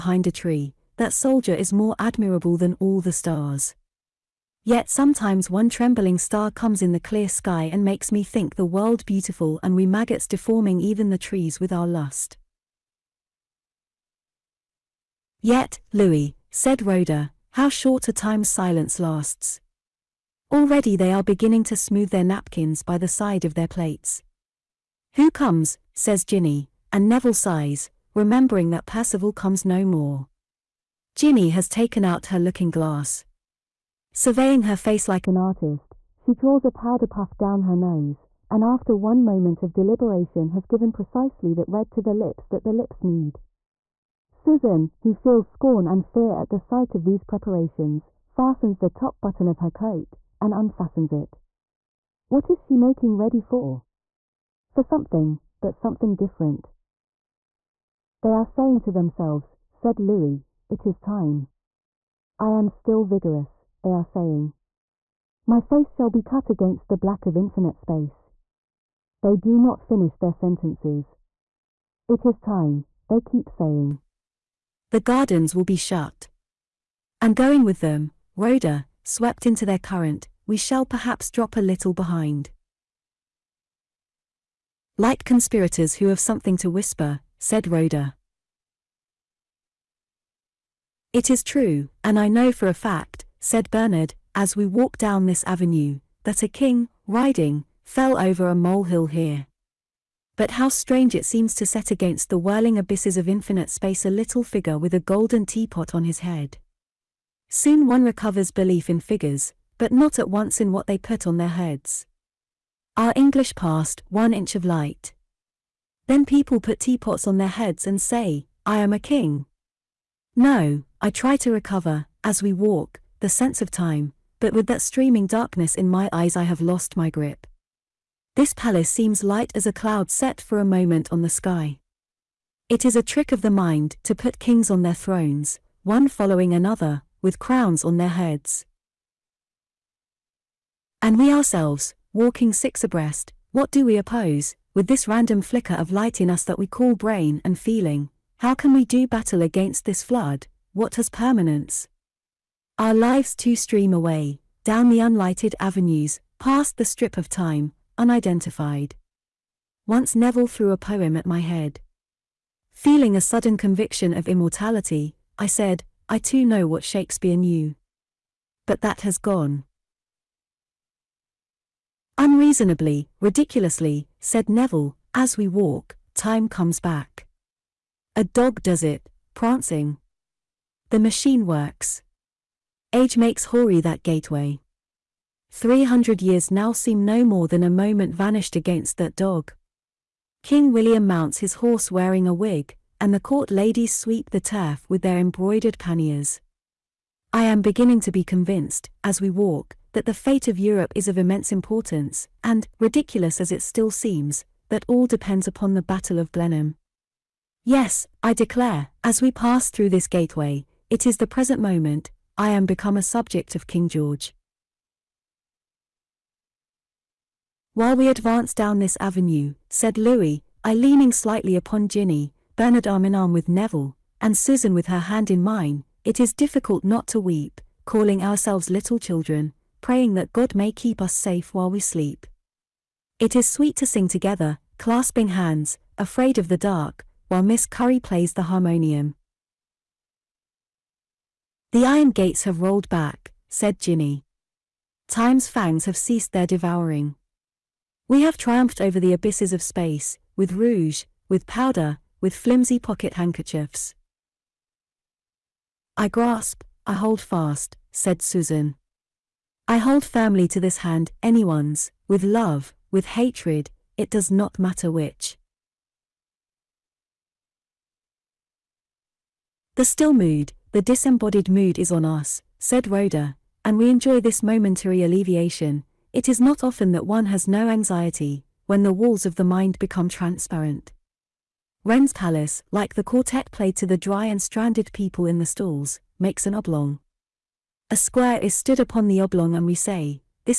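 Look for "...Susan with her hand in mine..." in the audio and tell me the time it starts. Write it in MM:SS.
03:44.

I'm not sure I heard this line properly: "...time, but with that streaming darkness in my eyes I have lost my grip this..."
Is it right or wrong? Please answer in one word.
right.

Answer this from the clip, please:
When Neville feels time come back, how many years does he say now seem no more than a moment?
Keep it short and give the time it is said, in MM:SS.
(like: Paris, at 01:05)
300, at 03:05.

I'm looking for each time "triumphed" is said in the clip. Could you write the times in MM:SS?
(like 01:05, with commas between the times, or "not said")
04:08.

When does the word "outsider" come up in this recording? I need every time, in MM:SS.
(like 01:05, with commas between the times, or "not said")
not said.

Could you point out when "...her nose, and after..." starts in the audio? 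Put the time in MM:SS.
00:37.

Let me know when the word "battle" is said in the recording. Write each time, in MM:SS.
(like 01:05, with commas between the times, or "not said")
02:29, 03:25.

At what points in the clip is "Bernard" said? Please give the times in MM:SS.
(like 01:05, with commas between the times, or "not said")
01:33, 03:42.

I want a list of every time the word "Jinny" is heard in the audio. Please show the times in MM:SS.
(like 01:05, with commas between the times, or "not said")
00:26, 00:31, 03:41, 04:03.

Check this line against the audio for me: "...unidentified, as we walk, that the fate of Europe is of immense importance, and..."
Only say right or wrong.
wrong.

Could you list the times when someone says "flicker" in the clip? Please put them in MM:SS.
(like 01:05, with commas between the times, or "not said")
02:25.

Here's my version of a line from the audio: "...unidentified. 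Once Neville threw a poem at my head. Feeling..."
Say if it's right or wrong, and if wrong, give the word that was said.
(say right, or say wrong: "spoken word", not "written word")
right.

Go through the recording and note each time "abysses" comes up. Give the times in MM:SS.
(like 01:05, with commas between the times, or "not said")
01:42, 04:09.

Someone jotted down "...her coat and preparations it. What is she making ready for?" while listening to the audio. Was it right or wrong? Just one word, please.
wrong.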